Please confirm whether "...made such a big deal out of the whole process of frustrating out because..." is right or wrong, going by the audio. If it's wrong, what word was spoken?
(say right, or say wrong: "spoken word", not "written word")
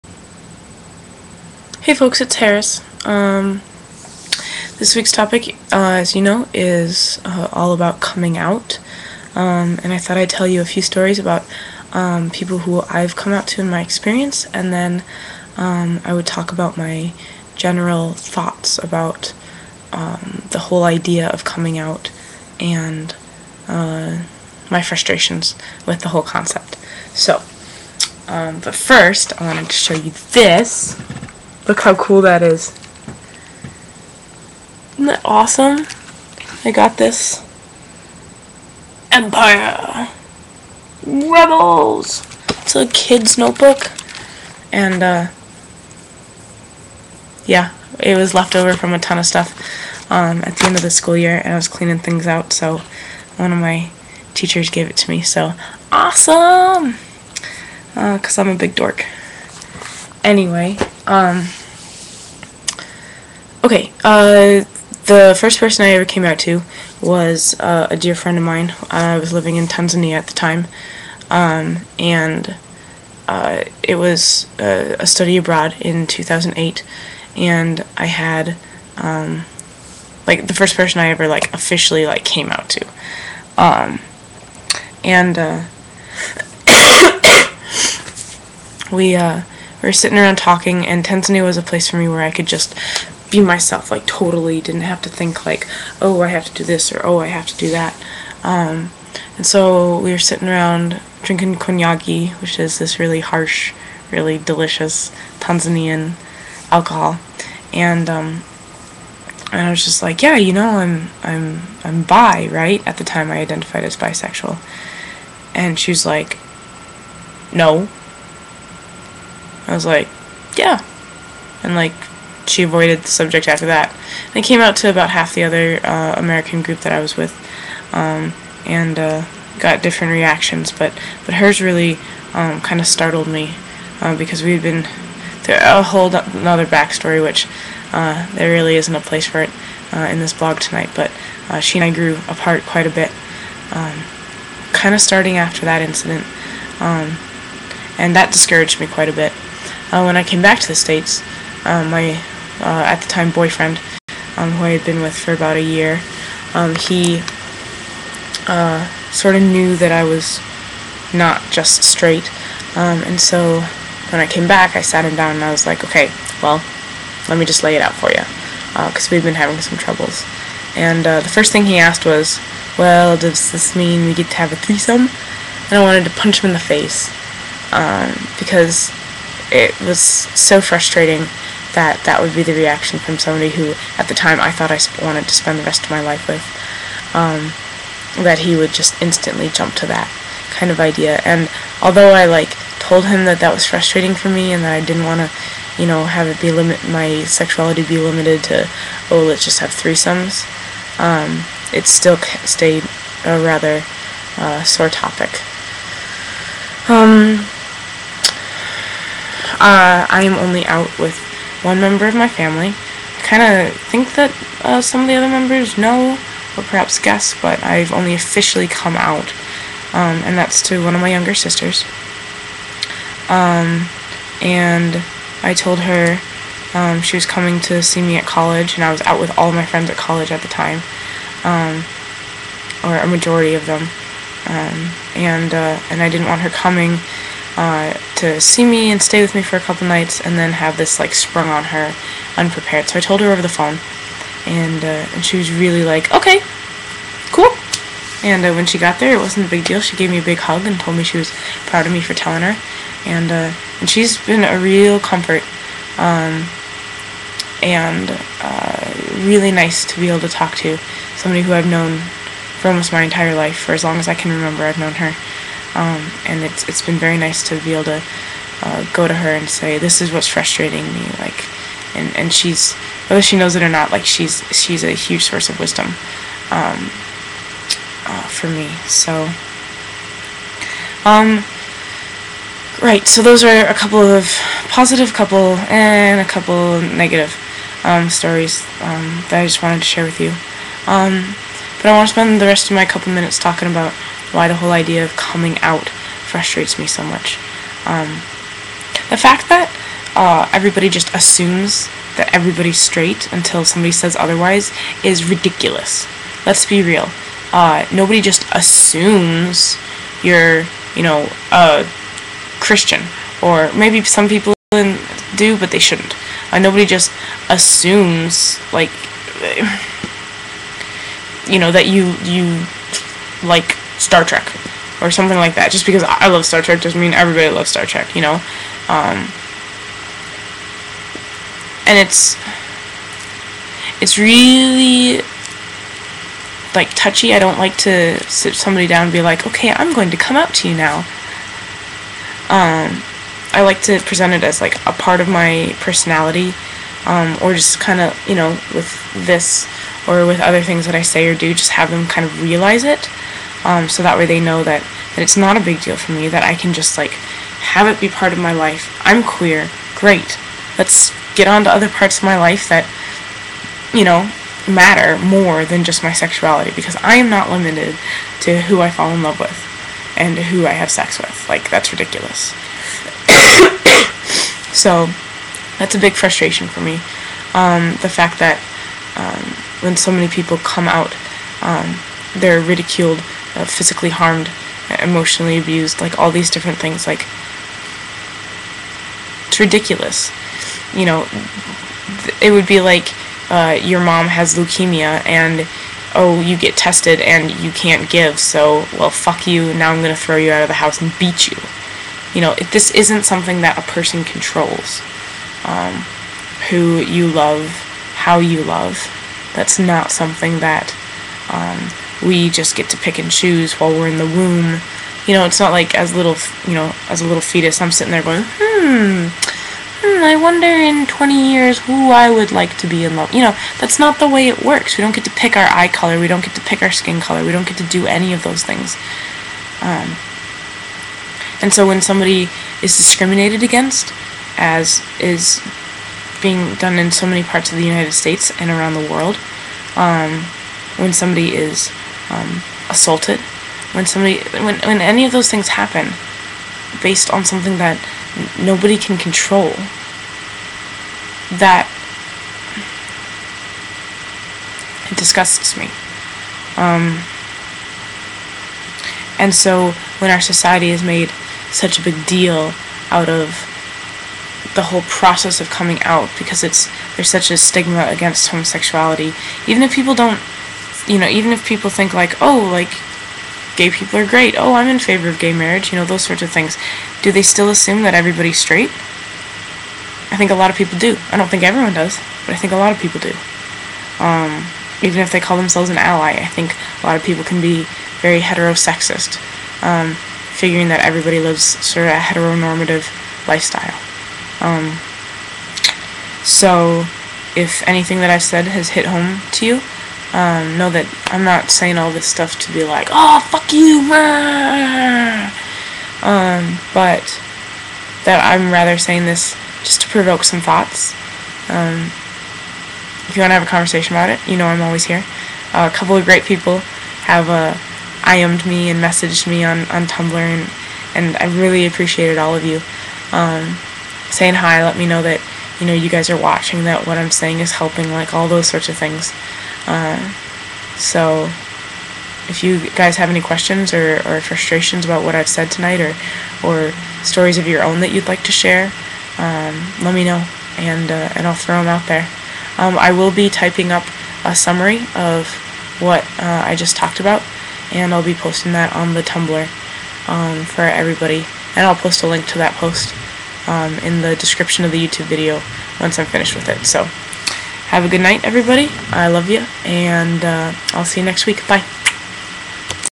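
wrong: "coming", not "frustrating".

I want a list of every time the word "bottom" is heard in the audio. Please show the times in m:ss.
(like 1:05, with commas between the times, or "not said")
not said.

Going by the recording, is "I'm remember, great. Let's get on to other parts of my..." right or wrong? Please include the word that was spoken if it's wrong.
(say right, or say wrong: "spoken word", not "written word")
wrong: "queer", not "remember".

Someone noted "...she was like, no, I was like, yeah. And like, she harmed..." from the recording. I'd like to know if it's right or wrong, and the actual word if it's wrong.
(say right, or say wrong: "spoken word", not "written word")
wrong: "avoided", not "harmed".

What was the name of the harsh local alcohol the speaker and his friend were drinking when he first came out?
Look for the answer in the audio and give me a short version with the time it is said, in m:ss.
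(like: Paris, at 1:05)
konyagi, at 1:41.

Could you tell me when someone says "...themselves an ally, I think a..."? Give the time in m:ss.
8:05.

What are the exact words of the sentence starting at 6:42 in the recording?
You know, if this isn't something that a person controls.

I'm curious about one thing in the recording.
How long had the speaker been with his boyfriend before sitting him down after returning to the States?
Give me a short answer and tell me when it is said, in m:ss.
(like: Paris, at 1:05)
about a year, at 2:35.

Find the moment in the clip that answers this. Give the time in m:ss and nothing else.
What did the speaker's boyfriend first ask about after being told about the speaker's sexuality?
2:54.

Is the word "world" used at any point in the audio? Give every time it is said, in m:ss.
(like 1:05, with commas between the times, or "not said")
7:19.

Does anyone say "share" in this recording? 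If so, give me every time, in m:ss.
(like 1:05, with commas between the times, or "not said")
4:49, 8:58.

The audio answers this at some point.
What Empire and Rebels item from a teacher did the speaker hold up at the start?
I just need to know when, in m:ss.
0:42.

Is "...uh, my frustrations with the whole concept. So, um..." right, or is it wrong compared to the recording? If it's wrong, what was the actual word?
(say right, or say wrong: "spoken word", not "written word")
right.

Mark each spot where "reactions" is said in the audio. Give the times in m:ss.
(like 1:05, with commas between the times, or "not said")
2:10, 3:02.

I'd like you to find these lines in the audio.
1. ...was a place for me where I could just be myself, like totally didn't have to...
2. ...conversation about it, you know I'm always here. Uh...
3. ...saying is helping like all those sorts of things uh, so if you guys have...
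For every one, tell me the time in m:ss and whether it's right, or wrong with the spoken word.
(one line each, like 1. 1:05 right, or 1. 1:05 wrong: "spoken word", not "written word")
1. 1:31 right
2. 8:33 right
3. 8:47 right.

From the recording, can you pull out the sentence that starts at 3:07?
Um, that he would just instantly jump to that kind of idea.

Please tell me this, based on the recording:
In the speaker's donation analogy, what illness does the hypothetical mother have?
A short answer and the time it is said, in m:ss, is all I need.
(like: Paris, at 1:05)
leukemia, at 6:34.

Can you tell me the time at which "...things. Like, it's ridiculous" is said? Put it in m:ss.
6:26.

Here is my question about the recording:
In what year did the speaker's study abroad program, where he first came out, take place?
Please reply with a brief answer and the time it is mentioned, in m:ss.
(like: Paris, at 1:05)
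2008, at 1:16.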